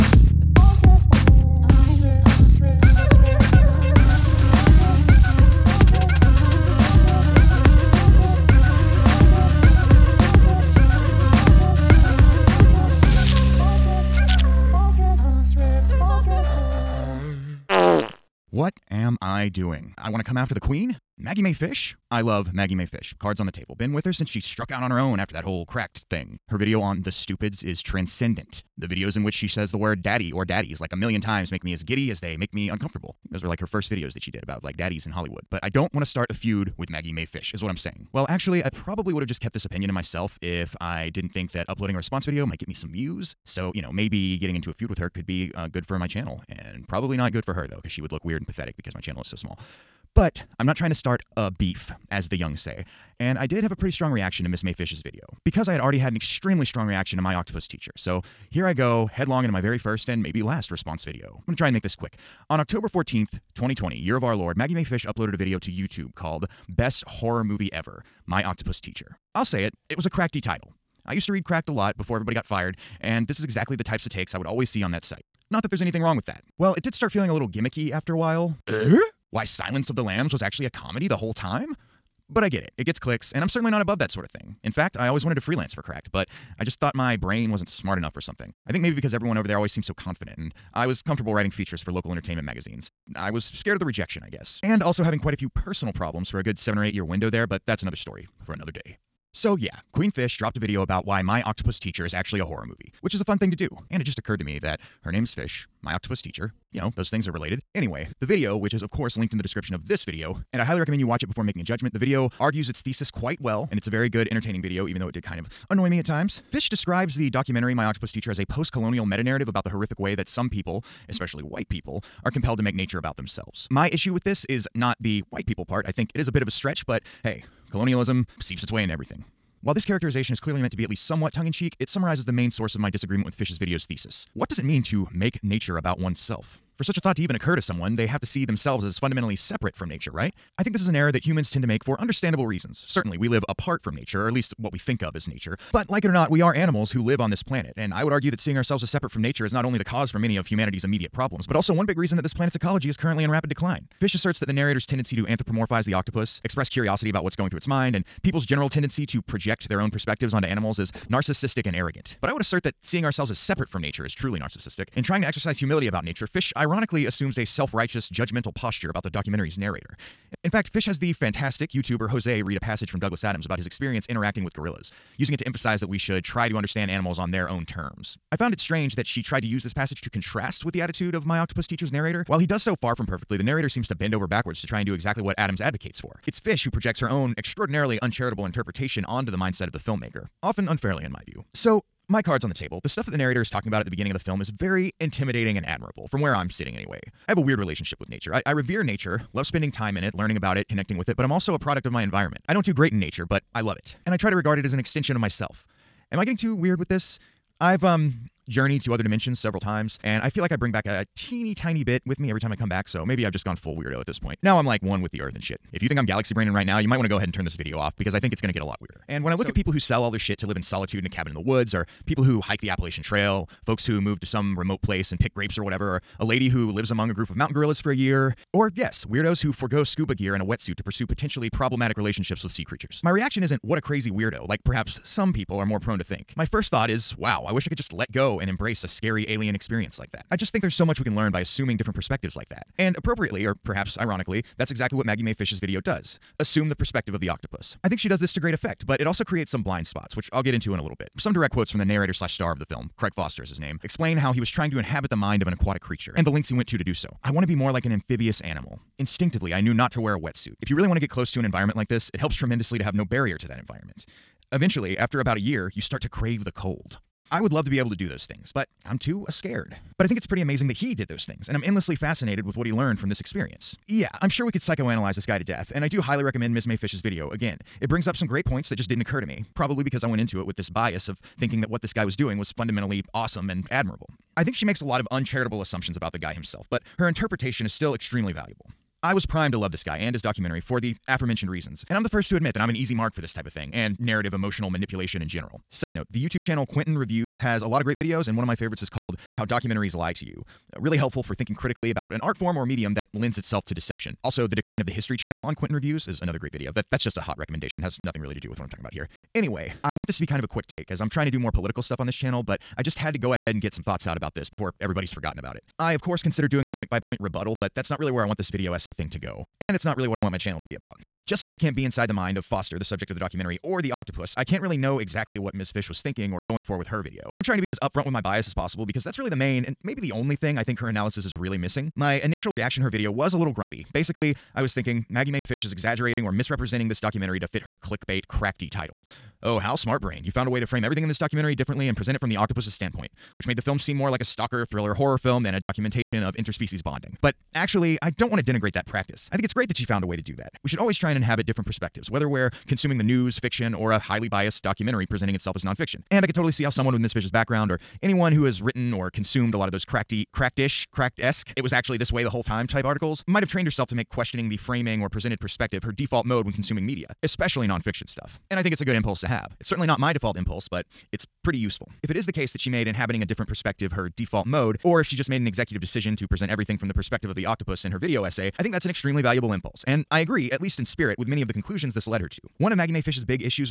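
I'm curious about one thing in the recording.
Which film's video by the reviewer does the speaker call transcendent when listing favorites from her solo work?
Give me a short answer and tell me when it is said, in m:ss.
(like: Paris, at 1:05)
The Stupids, at 0:27.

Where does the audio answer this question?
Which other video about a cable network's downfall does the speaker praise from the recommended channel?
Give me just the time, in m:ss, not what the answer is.
5:04.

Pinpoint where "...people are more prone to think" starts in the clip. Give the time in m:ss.
3:55.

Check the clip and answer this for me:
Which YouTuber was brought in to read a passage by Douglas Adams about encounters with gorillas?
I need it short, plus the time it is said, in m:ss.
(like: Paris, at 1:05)
Jose, at 2:52.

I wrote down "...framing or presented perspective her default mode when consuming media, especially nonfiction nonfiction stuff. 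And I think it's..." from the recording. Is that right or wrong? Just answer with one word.
right.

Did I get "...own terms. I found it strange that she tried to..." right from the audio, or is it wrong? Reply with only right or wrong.
right.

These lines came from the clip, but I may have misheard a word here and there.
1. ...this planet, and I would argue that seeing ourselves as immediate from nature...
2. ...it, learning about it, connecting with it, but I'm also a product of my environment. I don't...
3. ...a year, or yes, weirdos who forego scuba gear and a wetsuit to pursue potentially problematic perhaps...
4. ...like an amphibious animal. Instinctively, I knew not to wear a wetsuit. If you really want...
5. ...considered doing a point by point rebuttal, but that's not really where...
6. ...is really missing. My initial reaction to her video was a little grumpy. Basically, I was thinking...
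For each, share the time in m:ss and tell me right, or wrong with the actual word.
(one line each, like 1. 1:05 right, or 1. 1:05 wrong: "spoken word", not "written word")
1. 2:27 wrong: "separate", not "immediate"
2. 3:20 right
3. 3:47 wrong: "relationships", not "perhaps"
4. 4:17 right
5. 5:16 right
6. 5:31 right.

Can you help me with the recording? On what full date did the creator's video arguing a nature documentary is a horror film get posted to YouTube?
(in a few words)
October 14, 2020.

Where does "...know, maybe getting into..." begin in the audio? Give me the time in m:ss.
0:43.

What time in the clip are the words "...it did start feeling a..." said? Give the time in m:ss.
1:16.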